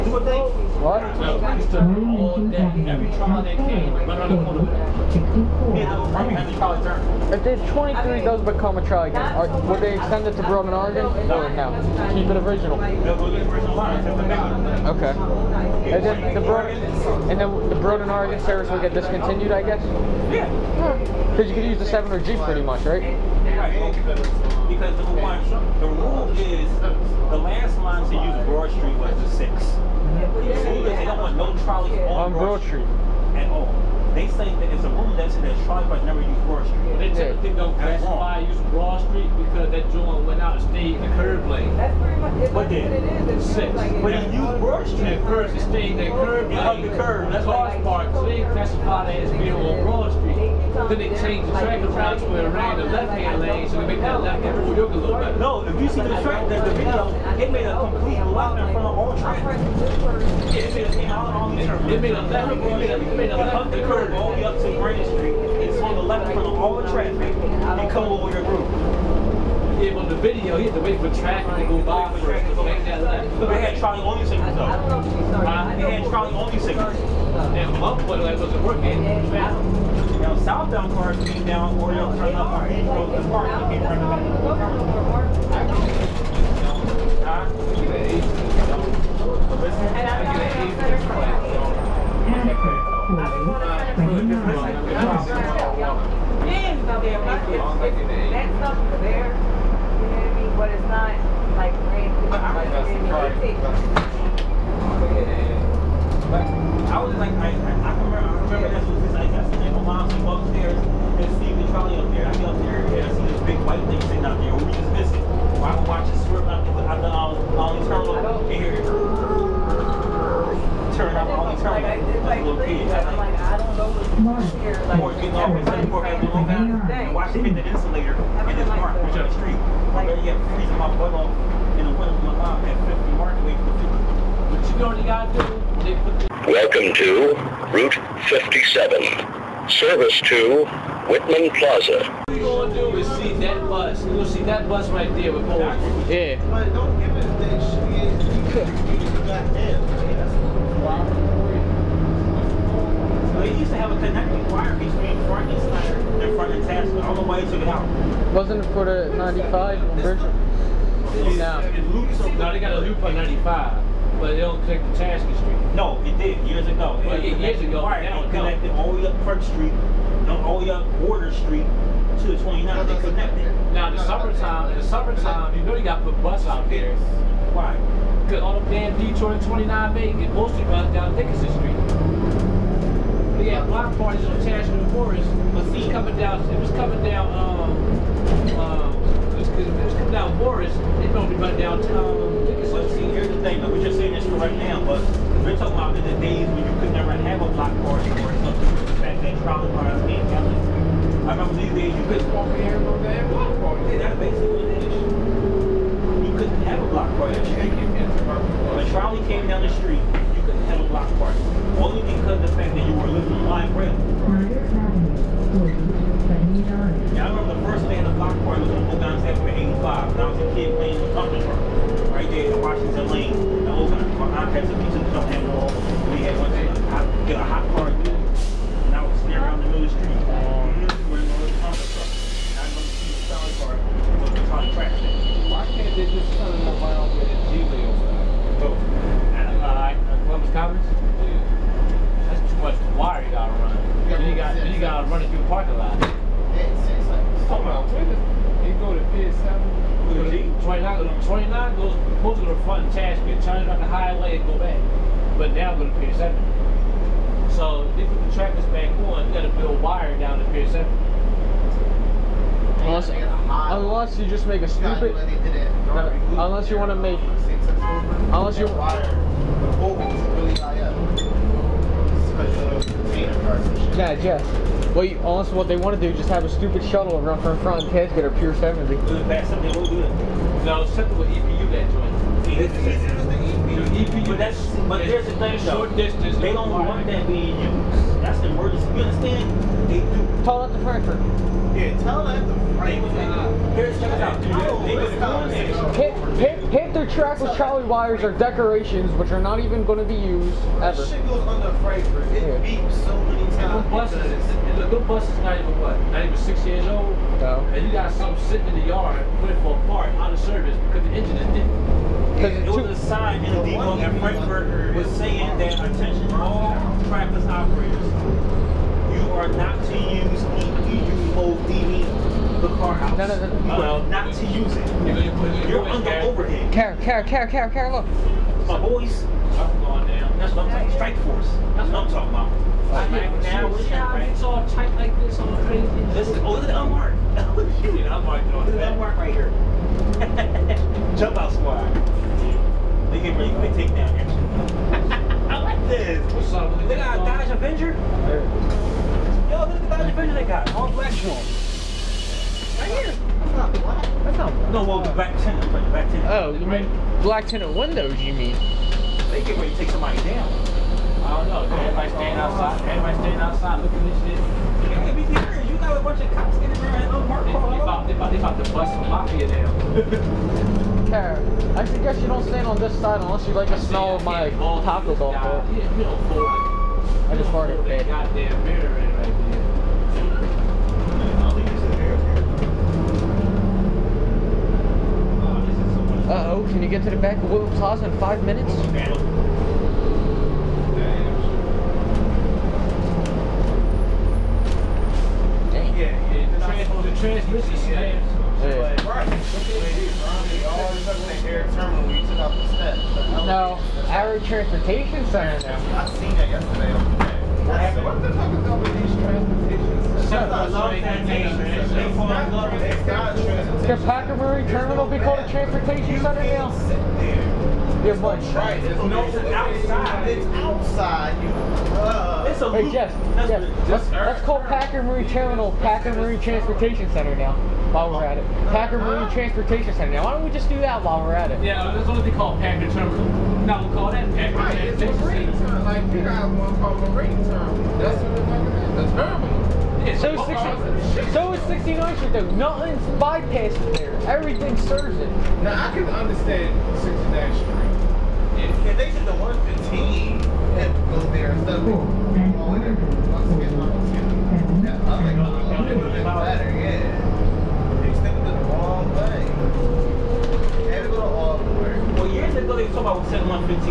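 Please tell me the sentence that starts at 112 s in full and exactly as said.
I get up there and I see this big white thing sitting out there.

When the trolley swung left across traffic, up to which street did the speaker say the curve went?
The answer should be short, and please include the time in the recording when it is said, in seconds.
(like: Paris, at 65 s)
Grand Street, at 64 s.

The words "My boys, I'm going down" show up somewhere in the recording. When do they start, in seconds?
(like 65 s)
328 s.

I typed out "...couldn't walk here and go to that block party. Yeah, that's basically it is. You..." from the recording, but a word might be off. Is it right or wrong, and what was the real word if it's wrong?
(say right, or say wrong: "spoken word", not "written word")
right.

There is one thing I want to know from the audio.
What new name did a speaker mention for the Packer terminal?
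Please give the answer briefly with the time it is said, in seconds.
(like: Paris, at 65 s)
Packer Marine Transportation Center, at 425 s.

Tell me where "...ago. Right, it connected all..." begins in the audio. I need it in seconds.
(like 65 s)
167 s.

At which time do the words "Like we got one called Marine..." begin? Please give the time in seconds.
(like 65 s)
435 s.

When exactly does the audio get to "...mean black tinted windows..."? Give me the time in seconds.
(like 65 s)
356 s.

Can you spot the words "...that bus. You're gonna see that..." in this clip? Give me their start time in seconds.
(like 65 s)
143 s.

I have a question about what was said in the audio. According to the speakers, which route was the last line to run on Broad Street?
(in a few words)
6.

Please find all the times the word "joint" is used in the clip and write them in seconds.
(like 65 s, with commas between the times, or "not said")
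39 s, 281 s.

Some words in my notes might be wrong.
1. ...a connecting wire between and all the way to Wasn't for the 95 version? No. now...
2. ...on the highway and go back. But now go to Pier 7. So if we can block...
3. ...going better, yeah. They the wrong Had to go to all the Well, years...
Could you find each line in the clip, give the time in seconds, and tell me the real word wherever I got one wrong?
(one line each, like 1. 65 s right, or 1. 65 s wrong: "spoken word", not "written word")
1. 153 s right
2. 253 s wrong: "track", not "block"
3. 451 s right.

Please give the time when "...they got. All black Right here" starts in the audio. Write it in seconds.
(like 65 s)
350 s.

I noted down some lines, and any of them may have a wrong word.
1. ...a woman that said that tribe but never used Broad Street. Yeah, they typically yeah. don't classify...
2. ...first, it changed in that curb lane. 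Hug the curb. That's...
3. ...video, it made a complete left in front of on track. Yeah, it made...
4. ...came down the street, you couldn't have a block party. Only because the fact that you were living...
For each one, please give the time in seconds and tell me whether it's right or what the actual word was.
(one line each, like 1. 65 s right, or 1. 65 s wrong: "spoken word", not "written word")
1. 34 s right
2. 45 s wrong: "stayed", not "changed"
3. 56 s right
4. 209 s right.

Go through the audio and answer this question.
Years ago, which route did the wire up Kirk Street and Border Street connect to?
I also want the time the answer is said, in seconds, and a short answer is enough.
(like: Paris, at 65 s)
29, at 172 s.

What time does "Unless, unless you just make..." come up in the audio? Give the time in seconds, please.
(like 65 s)
262 s.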